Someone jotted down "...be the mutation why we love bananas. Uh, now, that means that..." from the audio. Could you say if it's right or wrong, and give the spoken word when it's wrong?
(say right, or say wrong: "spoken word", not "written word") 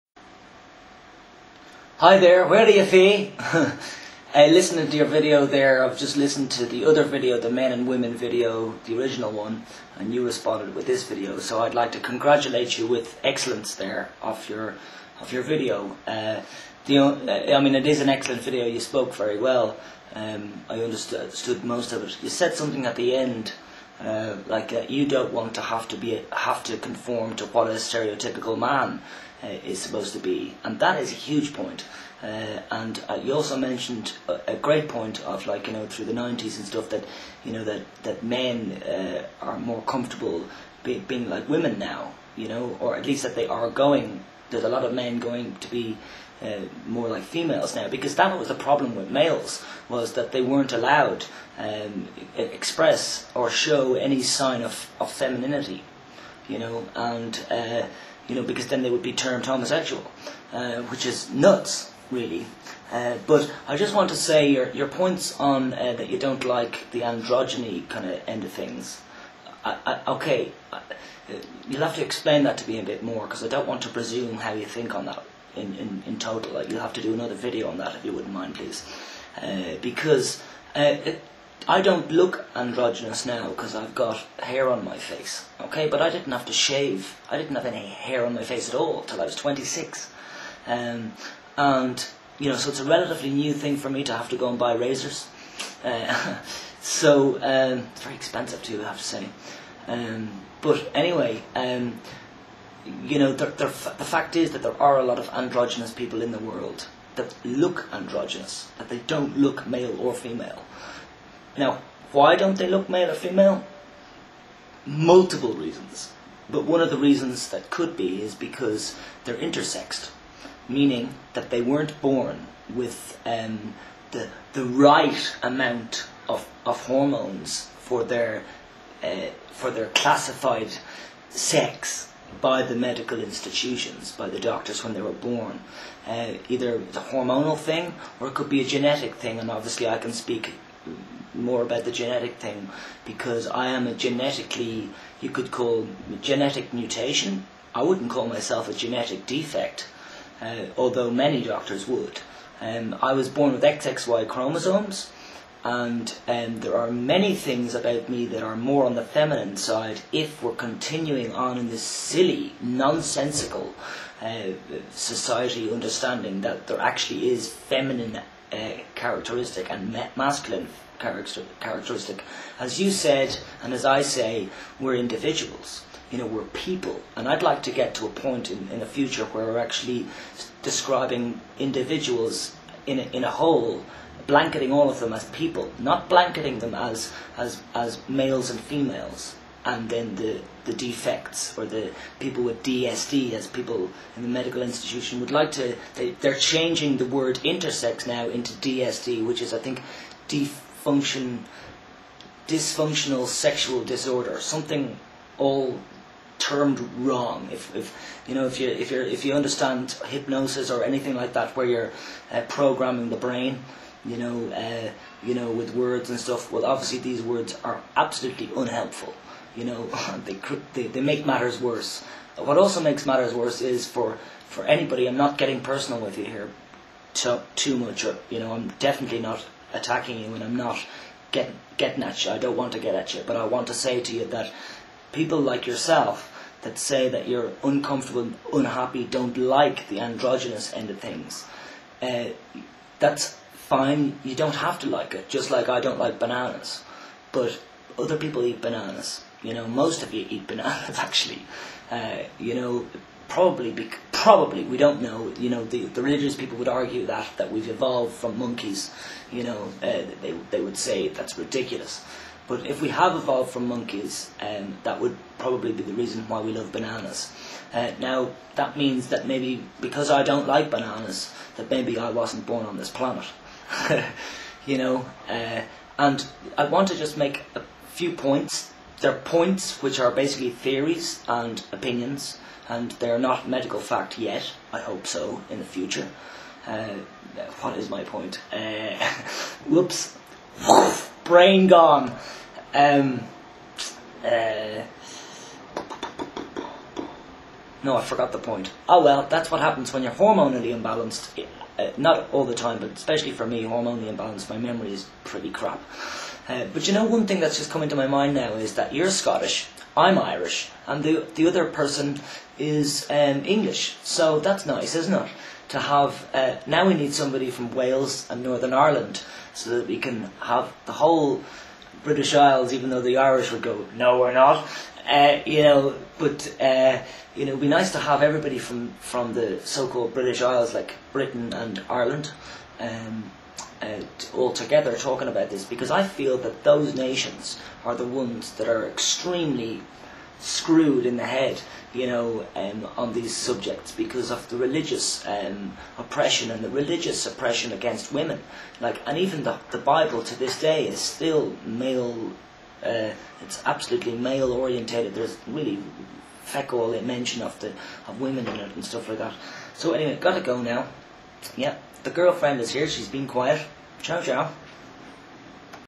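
wrong: "reason", not "mutation".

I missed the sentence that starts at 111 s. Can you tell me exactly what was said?
Now, why don't they look male or female?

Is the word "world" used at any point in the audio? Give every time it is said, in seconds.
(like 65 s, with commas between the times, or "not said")
106 s.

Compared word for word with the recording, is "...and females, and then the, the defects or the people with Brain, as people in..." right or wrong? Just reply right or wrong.
wrong.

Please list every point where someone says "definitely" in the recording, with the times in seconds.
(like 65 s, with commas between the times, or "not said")
228 s.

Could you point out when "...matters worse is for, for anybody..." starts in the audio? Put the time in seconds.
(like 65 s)
223 s.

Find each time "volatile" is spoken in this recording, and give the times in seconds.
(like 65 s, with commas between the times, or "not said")
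not said.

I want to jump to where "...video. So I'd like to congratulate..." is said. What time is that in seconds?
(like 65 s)
11 s.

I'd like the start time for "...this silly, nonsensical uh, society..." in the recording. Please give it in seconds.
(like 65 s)
161 s.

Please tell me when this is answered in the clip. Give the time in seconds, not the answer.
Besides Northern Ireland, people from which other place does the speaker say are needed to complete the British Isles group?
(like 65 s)
317 s.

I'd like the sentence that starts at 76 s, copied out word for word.
Like, you'll have to do another video on that if you wouldn't mind, please.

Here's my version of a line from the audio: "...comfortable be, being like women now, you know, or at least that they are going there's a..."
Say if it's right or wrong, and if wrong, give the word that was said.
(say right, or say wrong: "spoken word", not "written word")
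right.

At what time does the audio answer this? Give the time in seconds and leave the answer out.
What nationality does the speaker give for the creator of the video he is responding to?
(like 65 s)
309 s.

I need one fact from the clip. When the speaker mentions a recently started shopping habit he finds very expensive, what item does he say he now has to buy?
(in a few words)
razors.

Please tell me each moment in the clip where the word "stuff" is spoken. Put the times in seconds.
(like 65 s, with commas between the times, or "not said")
36 s, 216 s, 358 s.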